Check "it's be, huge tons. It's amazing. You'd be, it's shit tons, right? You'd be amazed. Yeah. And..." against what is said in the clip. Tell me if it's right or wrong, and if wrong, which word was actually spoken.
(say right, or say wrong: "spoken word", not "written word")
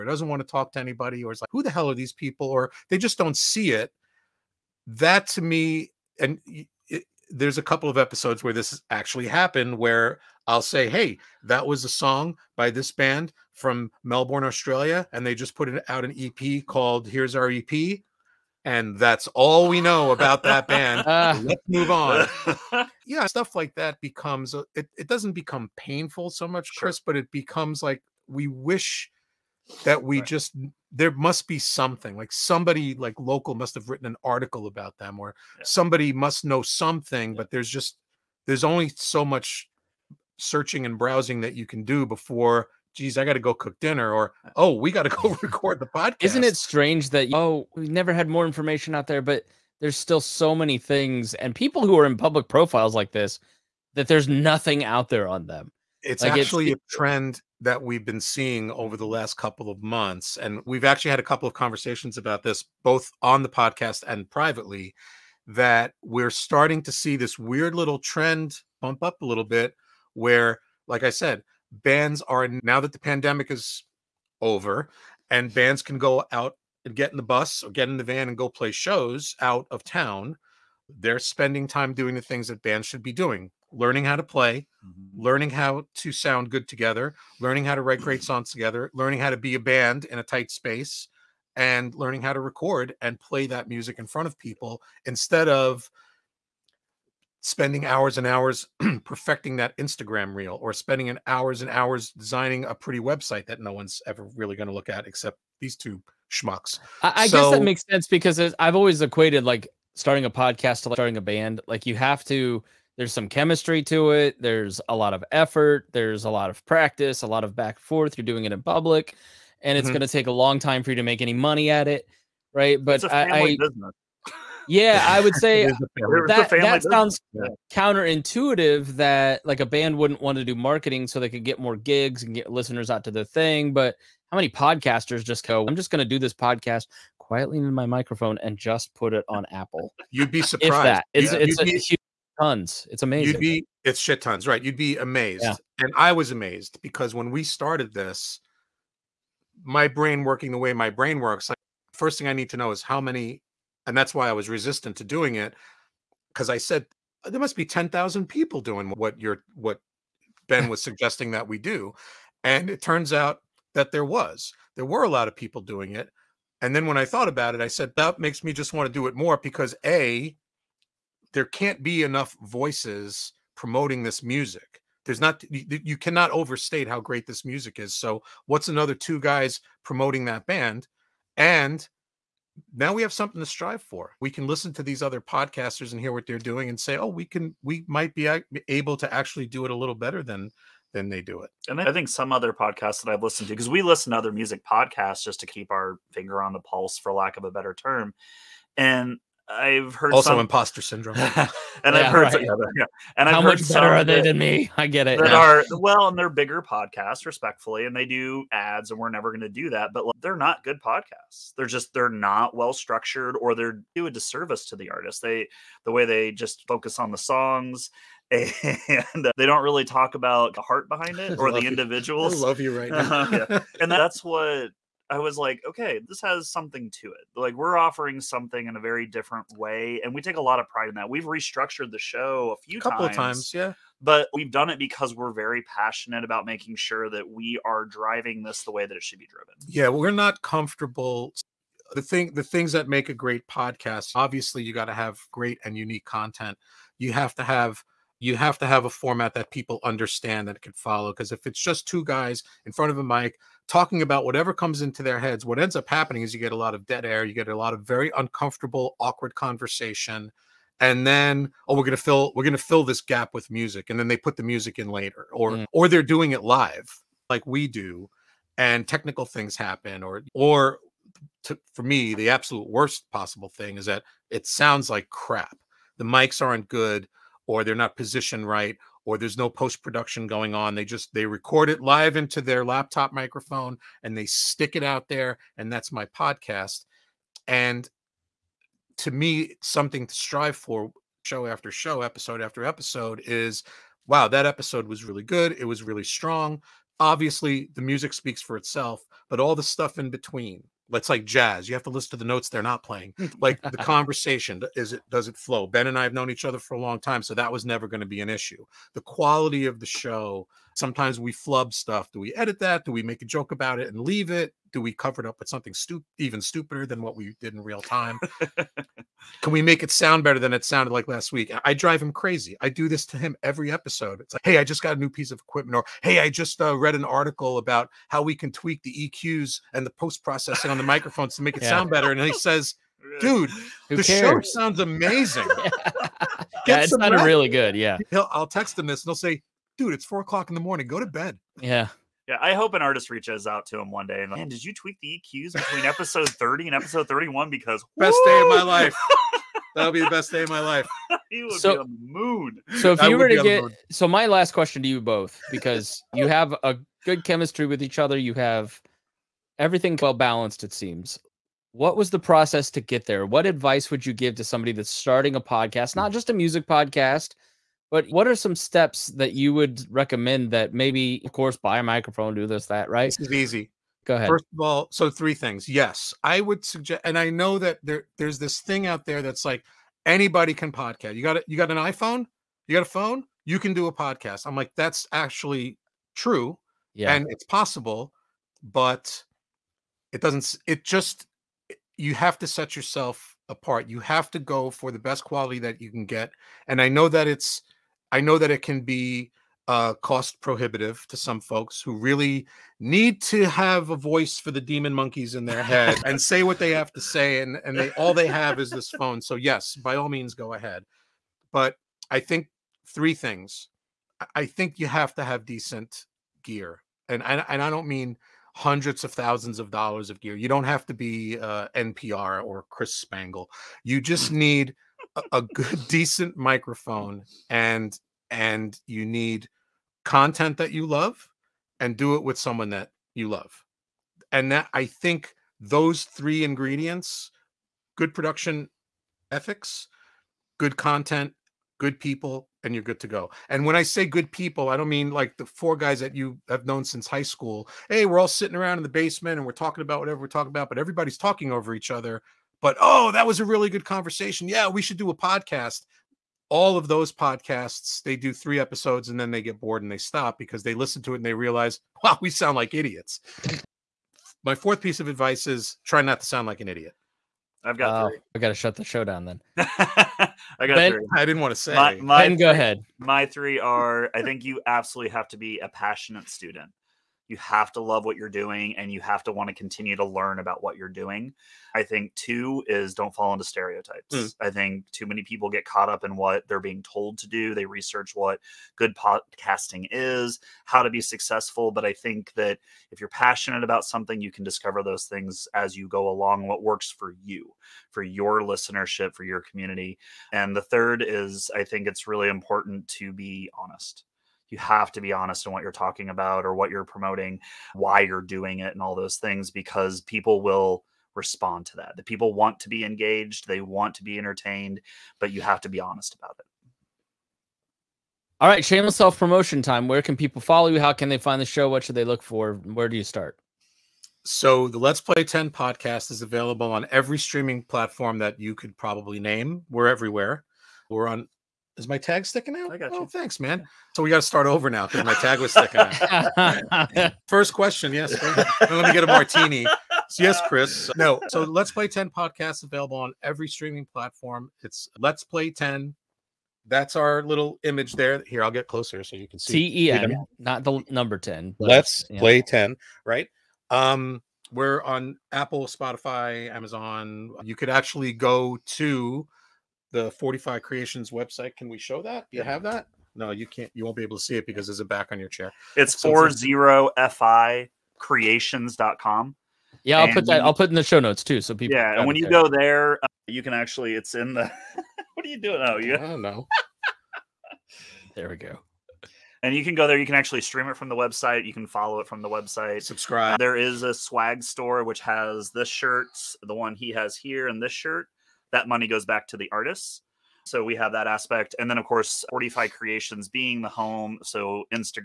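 right.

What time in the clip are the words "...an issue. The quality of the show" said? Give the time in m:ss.
5:08.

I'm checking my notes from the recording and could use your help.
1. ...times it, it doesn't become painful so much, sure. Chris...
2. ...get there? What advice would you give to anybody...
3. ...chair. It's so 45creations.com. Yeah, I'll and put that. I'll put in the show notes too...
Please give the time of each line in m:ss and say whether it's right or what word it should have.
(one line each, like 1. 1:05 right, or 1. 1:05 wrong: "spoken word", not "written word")
1. 0:24 wrong: "becomes", not "times"
2. 6:02 wrong: "somebody", not "anybody"
3. 9:25 right.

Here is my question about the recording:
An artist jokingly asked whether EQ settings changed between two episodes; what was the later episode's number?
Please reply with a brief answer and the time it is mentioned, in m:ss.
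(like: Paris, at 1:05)
31, at 5:46.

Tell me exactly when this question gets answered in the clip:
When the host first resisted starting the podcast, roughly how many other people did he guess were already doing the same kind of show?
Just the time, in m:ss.
2:37.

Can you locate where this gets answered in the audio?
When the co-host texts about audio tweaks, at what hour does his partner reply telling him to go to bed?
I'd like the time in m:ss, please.
5:40.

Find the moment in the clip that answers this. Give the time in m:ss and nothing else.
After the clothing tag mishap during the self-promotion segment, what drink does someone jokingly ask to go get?
8:59.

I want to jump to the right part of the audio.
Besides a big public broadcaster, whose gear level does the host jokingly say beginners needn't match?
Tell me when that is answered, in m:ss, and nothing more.
7:02.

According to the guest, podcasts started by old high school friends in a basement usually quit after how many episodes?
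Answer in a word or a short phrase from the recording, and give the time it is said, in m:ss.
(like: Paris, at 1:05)
3, at 7:38.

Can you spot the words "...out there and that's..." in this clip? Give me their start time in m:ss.
4:44.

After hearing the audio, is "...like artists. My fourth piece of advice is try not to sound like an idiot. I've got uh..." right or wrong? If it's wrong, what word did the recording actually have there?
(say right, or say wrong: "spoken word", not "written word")
wrong: "idiots", not "artists".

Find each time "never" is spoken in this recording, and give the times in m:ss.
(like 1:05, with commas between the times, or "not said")
0:47, 3:29, 5:07.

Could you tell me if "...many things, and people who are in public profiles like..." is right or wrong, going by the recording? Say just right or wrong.
right.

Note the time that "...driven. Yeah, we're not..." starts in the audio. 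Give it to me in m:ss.
3:59.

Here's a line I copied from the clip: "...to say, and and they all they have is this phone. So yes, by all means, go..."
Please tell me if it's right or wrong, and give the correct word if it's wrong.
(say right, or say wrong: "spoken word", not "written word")
right.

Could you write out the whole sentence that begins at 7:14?
And that I think those three ingredients good production ethics, good content, good people, and you're good to go.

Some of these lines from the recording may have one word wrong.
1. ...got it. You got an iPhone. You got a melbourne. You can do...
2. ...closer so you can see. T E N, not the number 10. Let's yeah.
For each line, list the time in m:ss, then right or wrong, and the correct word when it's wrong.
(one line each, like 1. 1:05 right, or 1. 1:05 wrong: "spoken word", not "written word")
1. 6:21 wrong: "phone", not "melbourne"
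2. 9:08 right.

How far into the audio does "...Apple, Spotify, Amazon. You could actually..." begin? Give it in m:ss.
9:15.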